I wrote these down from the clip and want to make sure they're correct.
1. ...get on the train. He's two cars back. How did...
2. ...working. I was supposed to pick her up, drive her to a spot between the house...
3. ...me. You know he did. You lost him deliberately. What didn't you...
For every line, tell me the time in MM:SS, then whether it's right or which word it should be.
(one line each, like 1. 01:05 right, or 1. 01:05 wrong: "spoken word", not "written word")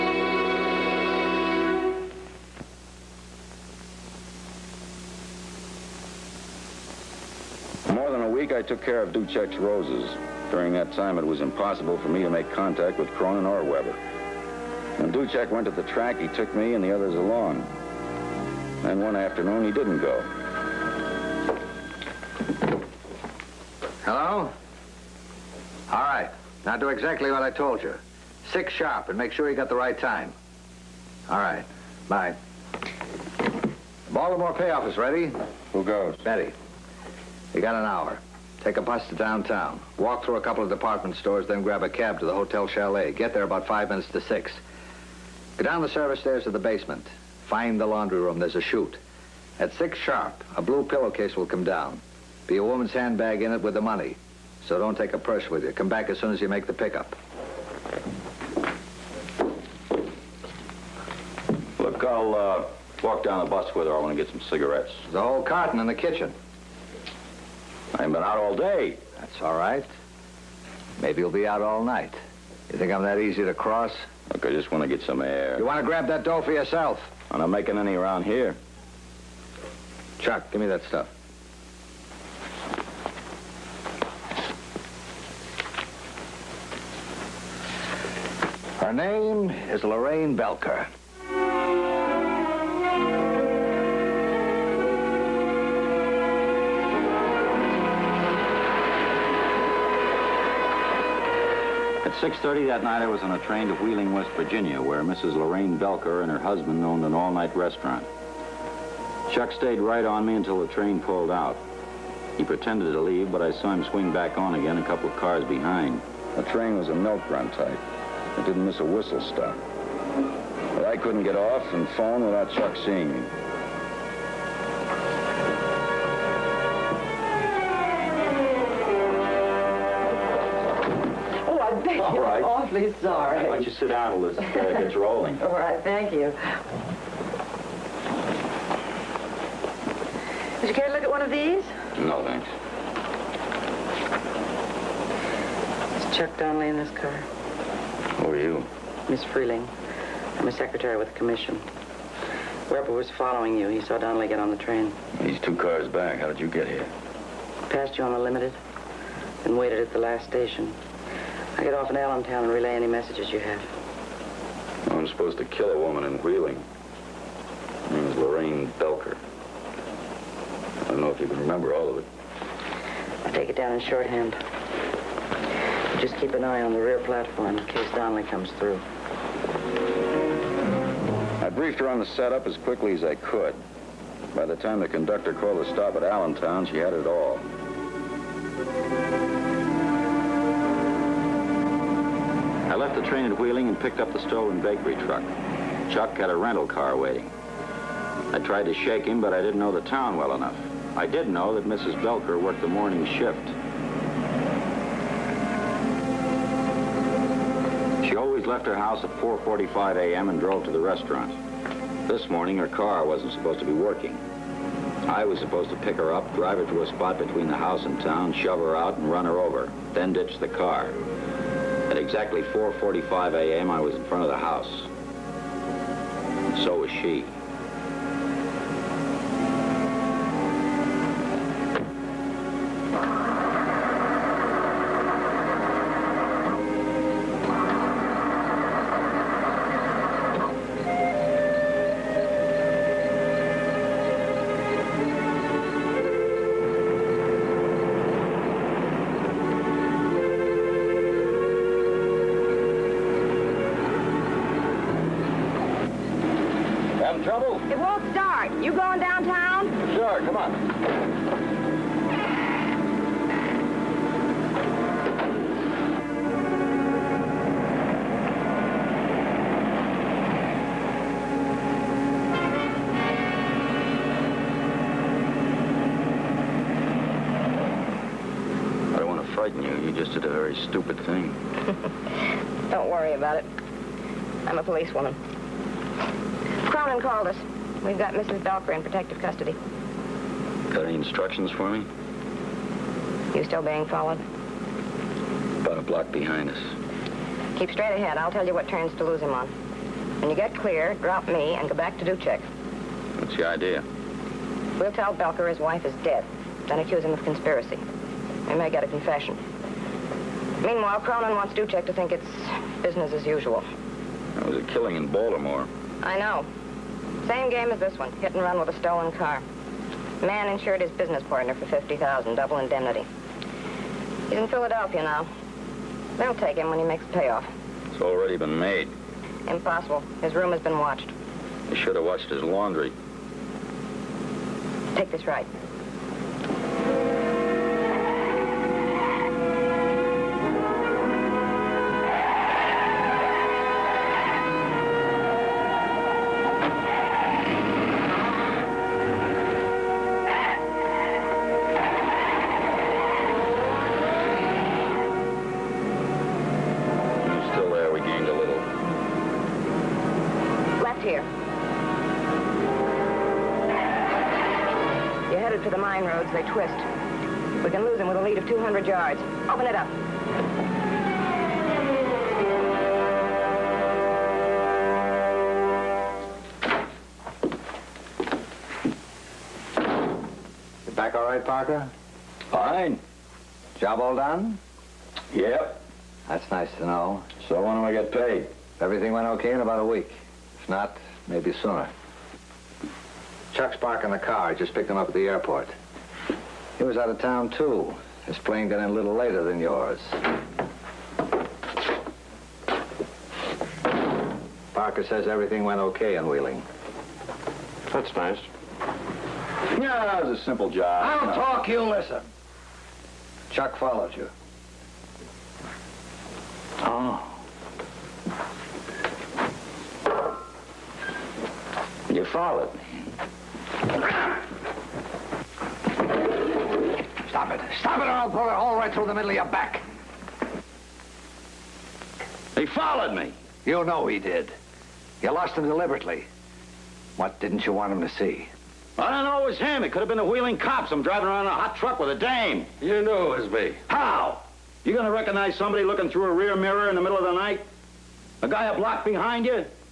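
1. 02:34 right
2. 03:33 right
3. 07:13 right.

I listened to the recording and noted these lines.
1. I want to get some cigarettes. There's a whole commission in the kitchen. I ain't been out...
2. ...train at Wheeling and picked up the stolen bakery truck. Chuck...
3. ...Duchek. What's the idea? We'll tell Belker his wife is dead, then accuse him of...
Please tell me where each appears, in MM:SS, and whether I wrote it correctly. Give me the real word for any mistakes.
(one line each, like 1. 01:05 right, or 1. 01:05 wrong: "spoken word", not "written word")
1. 01:03 wrong: "carton", not "commission"
2. 03:13 right
3. 05:02 right.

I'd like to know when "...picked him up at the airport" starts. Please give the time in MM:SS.
06:34.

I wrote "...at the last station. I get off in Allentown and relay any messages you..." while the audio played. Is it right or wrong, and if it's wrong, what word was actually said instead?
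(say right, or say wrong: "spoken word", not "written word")
right.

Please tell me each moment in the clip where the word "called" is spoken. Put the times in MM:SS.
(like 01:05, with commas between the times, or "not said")
03:05, 04:47.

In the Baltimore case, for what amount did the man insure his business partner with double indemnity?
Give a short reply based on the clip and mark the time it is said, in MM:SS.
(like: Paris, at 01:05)
50000, at 05:21.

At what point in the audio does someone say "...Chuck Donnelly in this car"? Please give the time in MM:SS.
02:26.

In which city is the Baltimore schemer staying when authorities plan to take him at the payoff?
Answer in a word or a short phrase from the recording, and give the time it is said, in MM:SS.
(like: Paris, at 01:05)
Philadelphia, at 05:24.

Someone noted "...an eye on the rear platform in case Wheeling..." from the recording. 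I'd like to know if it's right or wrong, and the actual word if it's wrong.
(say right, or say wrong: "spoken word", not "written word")
wrong: "Donnelly", not "Wheeling".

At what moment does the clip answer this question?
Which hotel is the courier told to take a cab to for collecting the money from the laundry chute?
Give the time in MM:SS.
00:42.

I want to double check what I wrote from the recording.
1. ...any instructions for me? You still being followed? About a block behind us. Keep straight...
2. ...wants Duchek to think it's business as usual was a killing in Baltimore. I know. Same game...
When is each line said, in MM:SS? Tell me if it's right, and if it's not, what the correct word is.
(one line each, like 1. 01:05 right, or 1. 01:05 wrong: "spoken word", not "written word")
1. 04:50 right
2. 05:11 right.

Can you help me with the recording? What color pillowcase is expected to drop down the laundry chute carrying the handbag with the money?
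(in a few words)
Blue.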